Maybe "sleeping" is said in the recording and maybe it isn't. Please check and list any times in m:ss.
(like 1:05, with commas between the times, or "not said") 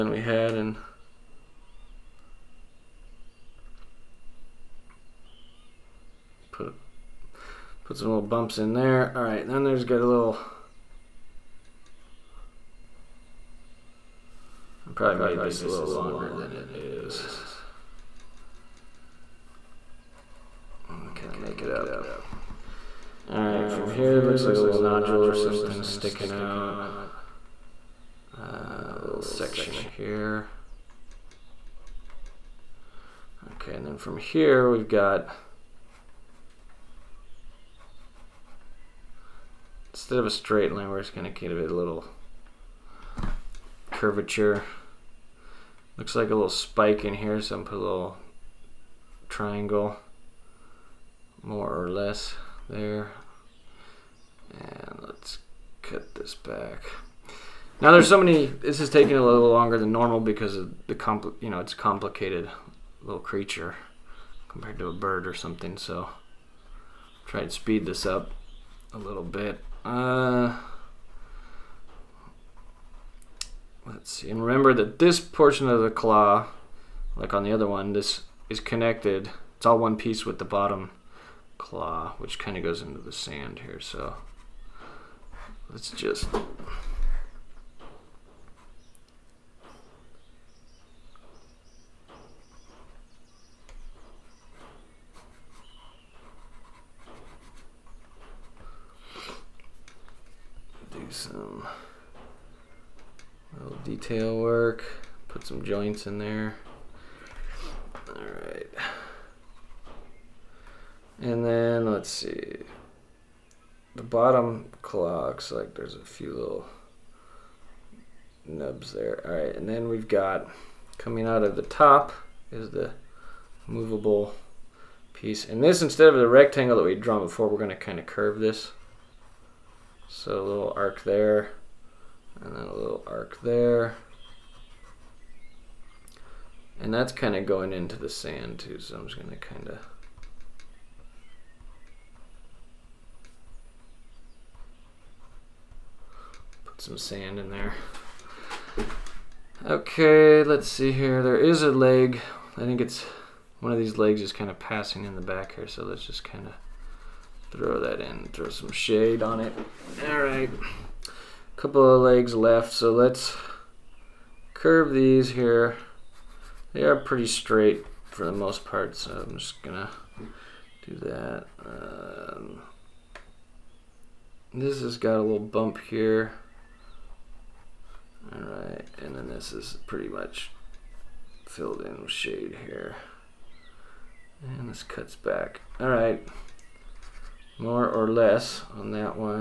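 not said.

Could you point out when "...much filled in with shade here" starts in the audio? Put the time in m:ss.
3:00.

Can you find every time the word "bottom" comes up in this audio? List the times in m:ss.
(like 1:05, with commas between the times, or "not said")
1:20, 1:54.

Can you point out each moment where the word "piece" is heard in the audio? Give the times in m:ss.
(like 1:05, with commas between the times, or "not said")
1:19, 2:05.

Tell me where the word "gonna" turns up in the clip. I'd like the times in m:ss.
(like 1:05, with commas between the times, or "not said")
0:41, 2:49.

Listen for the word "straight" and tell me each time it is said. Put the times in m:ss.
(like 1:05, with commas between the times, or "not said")
0:40, 2:47.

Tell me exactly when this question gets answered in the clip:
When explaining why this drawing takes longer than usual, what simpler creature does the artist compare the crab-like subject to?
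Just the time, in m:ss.
1:04.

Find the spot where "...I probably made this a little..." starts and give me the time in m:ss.
0:14.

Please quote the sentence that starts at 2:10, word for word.
So a little arc there, and then a little arc there.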